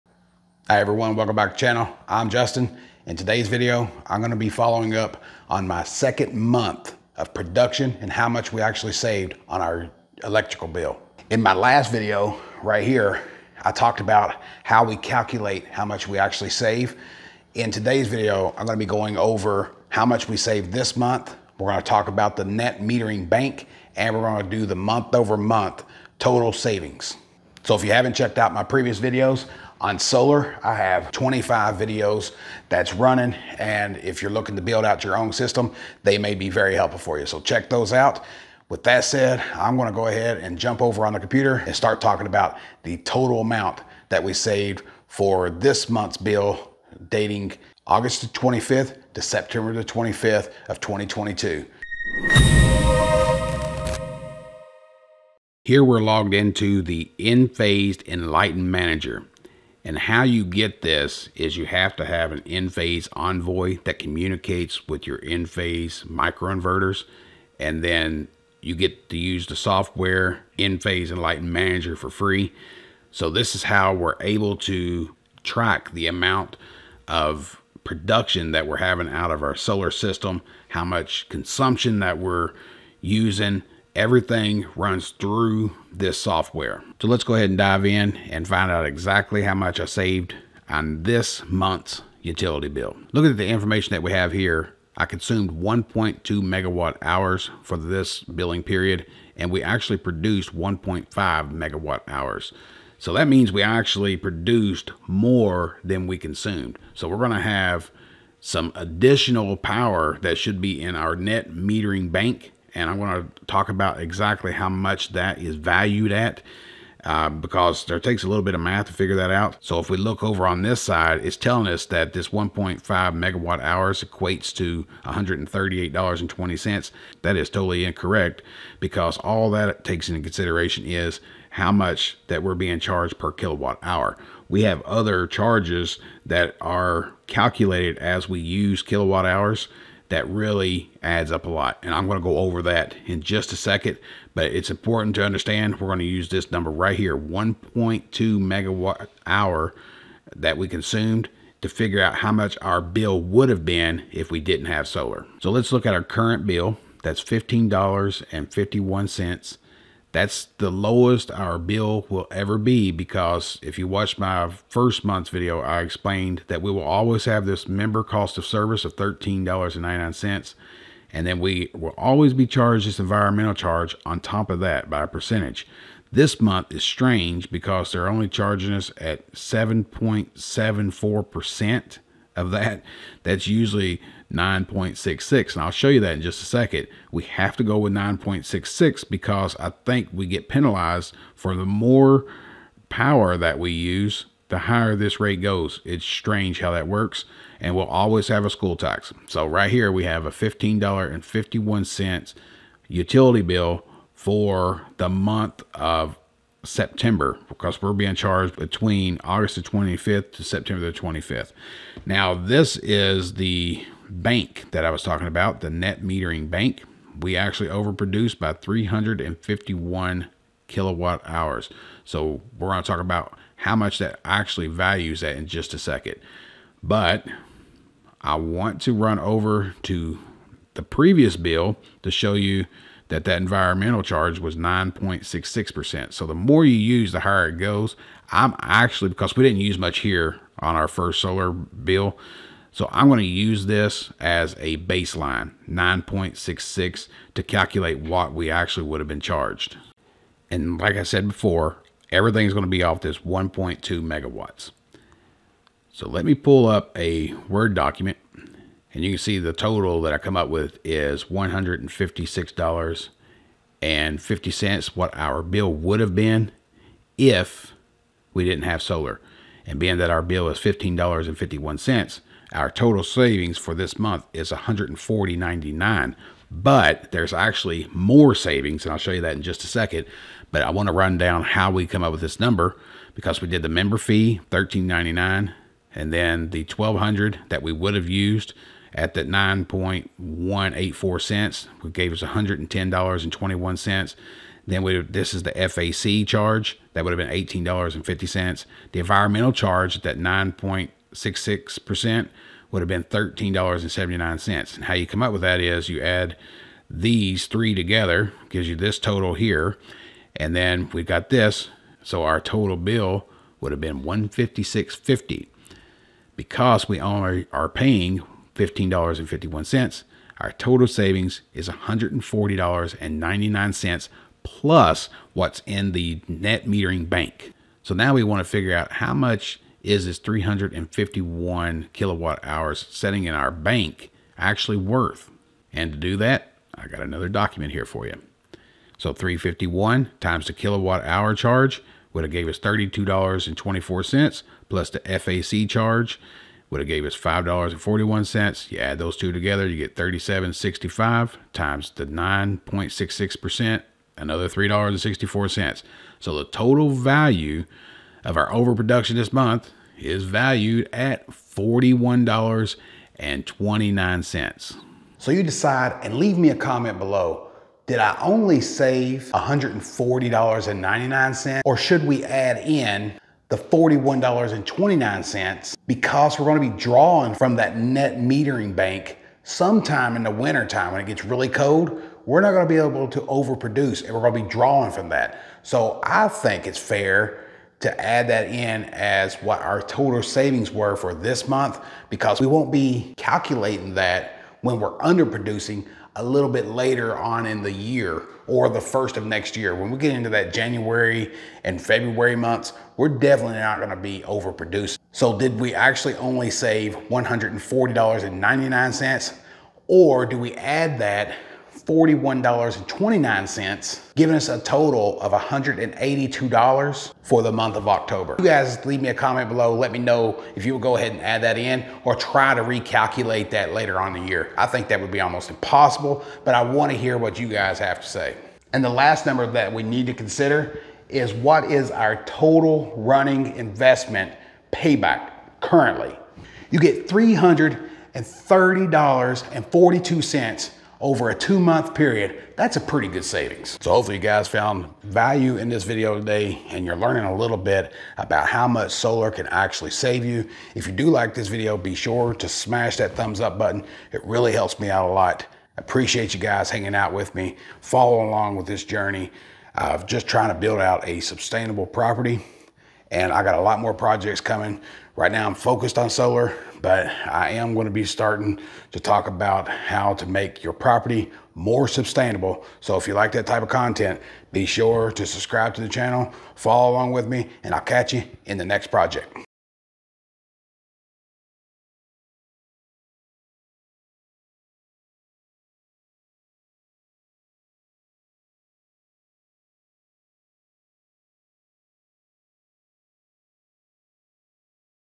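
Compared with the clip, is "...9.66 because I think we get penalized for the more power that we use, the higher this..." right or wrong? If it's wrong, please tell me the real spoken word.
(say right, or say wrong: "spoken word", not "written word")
right.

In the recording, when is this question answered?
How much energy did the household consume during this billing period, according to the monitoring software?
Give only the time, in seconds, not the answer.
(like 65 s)
95 s.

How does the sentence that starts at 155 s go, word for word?
So let's look at our current bill.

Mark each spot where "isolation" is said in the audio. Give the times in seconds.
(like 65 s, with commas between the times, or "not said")
not said.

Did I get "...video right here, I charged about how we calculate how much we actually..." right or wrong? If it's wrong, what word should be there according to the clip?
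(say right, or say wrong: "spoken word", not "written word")
wrong: "talked", not "charged".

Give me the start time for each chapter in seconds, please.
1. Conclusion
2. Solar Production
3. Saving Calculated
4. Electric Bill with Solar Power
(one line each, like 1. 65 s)
1. 365 s
2. 55 s
3. 257 s
4. 155 s.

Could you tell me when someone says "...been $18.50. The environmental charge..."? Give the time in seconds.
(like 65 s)
297 s.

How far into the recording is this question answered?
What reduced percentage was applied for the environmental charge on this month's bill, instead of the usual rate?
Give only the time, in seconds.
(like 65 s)
179 s.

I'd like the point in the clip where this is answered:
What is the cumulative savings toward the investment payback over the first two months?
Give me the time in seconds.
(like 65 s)
437 s.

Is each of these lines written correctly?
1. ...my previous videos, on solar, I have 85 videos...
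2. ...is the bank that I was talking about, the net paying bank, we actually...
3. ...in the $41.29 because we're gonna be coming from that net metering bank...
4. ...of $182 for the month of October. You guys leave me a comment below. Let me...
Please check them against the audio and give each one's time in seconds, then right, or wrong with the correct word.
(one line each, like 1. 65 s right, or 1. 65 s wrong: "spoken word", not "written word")
1. 28 s wrong: "25", not "85"
2. 212 s wrong: "metering", not "paying"
3. 372 s wrong: "drawing", not "coming"
4. 415 s right.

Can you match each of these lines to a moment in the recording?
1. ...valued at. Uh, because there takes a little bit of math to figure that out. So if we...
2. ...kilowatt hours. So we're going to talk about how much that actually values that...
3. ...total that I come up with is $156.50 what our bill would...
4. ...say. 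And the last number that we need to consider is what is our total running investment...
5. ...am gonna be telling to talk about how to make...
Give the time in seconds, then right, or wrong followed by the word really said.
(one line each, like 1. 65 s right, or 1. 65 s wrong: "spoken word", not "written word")
1. 115 s right
2. 220 s right
3. 259 s right
4. 428 s right
5. 467 s wrong: "starting", not "telling".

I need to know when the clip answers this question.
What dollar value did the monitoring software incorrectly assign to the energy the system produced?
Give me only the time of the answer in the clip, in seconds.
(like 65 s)
125 s.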